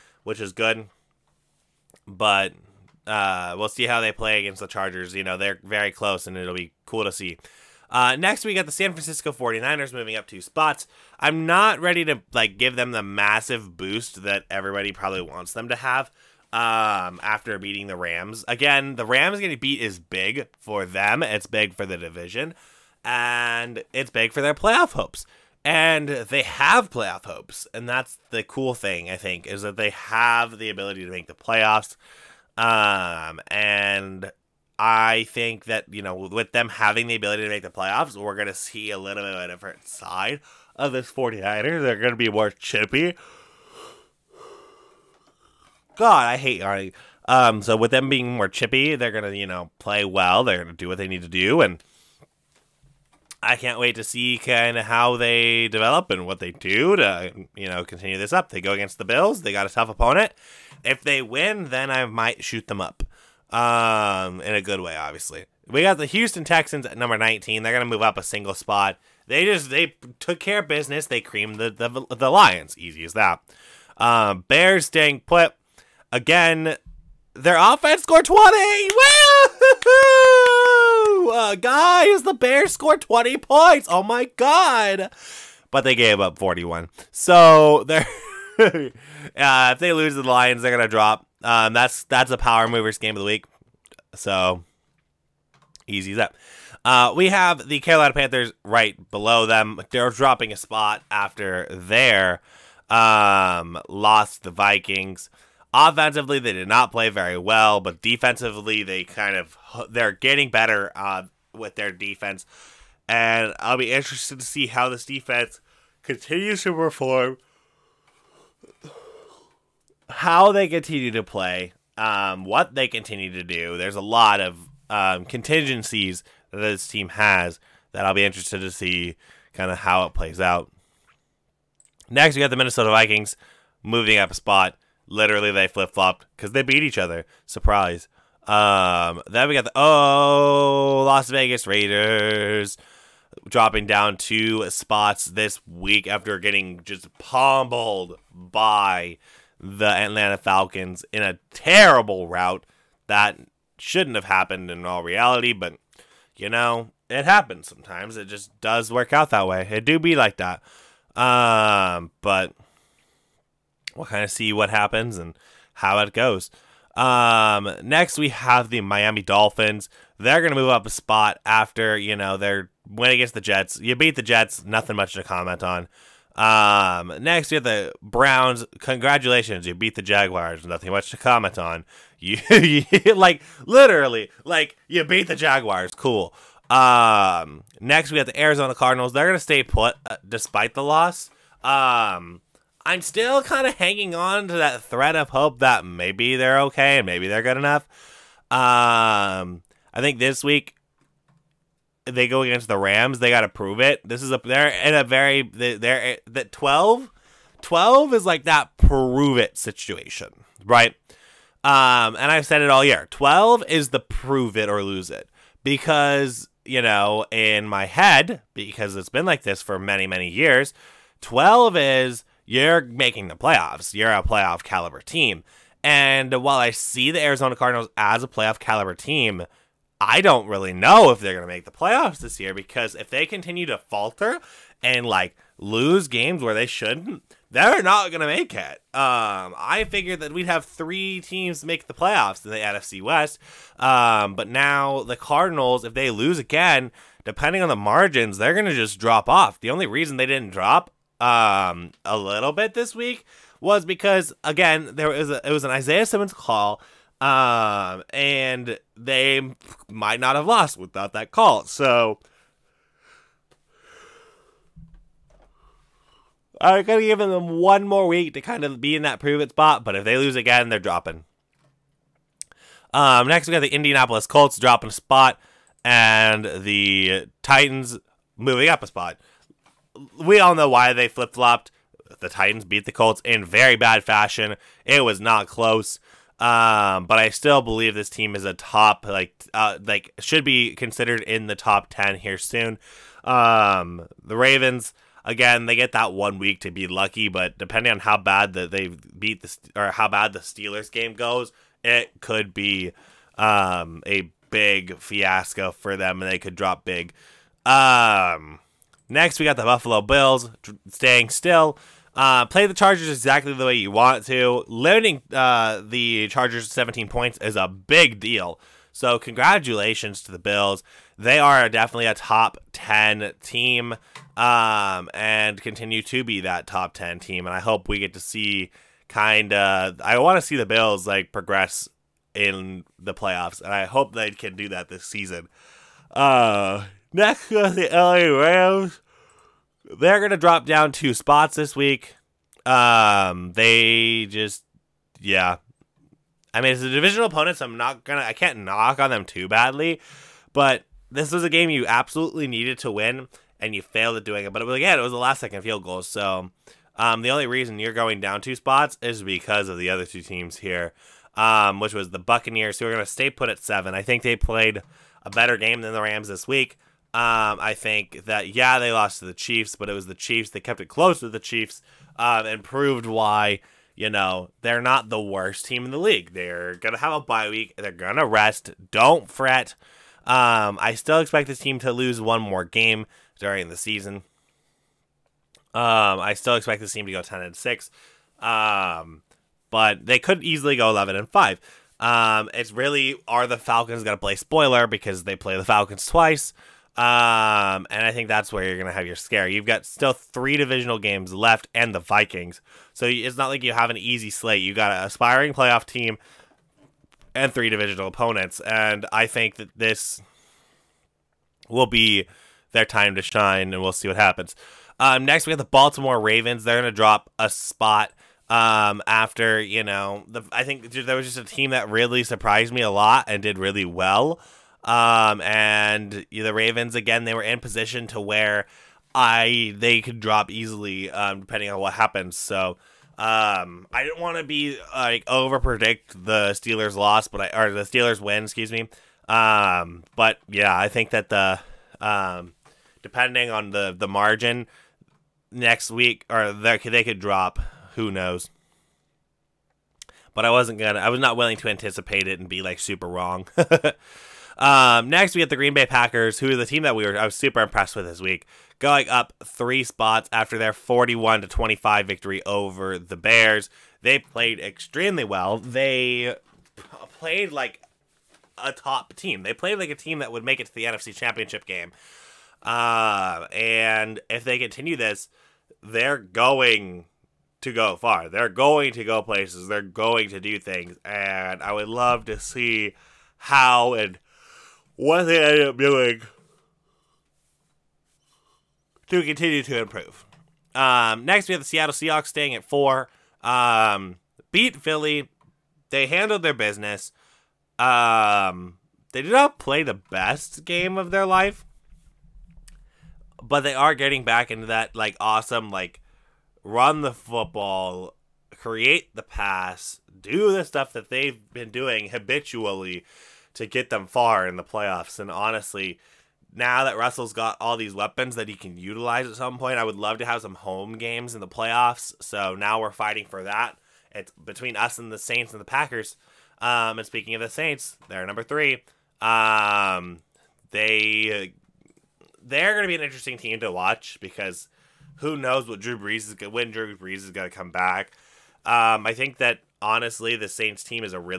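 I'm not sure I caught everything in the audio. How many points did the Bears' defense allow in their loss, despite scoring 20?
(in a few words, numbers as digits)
41.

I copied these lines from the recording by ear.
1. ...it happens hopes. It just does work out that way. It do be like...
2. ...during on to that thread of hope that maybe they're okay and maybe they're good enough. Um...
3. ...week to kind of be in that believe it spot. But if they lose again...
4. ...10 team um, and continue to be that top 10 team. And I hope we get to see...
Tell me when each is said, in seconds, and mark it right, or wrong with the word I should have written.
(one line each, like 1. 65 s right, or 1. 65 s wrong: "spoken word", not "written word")
1. 157 s wrong: "sometimes", not "hopes"
2. 193 s wrong: "hanging", not "during"
3. 268 s wrong: "prove", not "believe"
4. 322 s right.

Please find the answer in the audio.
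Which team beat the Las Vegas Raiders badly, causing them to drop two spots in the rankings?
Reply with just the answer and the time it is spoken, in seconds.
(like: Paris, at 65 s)
Atlanta Falcons, at 149 s.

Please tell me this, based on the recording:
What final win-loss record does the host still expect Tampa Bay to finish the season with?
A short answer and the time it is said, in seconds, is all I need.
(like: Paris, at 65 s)
10-6, at 387 s.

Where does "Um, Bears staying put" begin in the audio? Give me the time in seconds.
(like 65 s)
73 s.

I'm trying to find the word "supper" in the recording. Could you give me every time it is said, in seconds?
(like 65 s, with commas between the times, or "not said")
not said.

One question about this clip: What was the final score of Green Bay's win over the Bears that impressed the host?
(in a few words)
41-25.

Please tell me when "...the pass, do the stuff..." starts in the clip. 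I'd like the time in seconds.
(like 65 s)
509 s.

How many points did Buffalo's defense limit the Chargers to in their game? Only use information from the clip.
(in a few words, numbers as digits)
17.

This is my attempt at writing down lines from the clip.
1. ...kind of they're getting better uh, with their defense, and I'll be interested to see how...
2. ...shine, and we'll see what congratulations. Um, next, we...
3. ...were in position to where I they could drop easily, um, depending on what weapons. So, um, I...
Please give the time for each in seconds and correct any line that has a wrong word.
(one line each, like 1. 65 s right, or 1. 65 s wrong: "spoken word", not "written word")
1. 109 s right
2. 413 s wrong: "happens", not "congratulations"
3. 427 s wrong: "happens", not "weapons".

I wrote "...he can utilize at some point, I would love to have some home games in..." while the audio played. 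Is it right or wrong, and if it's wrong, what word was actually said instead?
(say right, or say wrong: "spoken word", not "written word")
right.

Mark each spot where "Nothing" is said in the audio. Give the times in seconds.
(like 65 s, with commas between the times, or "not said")
174 s, 180 s.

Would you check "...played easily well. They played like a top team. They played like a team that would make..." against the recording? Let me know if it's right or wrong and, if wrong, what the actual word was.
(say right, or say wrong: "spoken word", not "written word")
wrong: "extremely", not "easily".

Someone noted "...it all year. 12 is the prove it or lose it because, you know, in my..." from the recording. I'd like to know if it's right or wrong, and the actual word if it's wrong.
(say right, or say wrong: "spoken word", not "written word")
right.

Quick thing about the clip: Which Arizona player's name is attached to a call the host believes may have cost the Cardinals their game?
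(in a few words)
Isaiah Simmons.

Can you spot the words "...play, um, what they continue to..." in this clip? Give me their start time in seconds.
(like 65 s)
121 s.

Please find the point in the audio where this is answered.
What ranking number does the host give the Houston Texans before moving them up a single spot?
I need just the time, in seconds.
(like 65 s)
66 s.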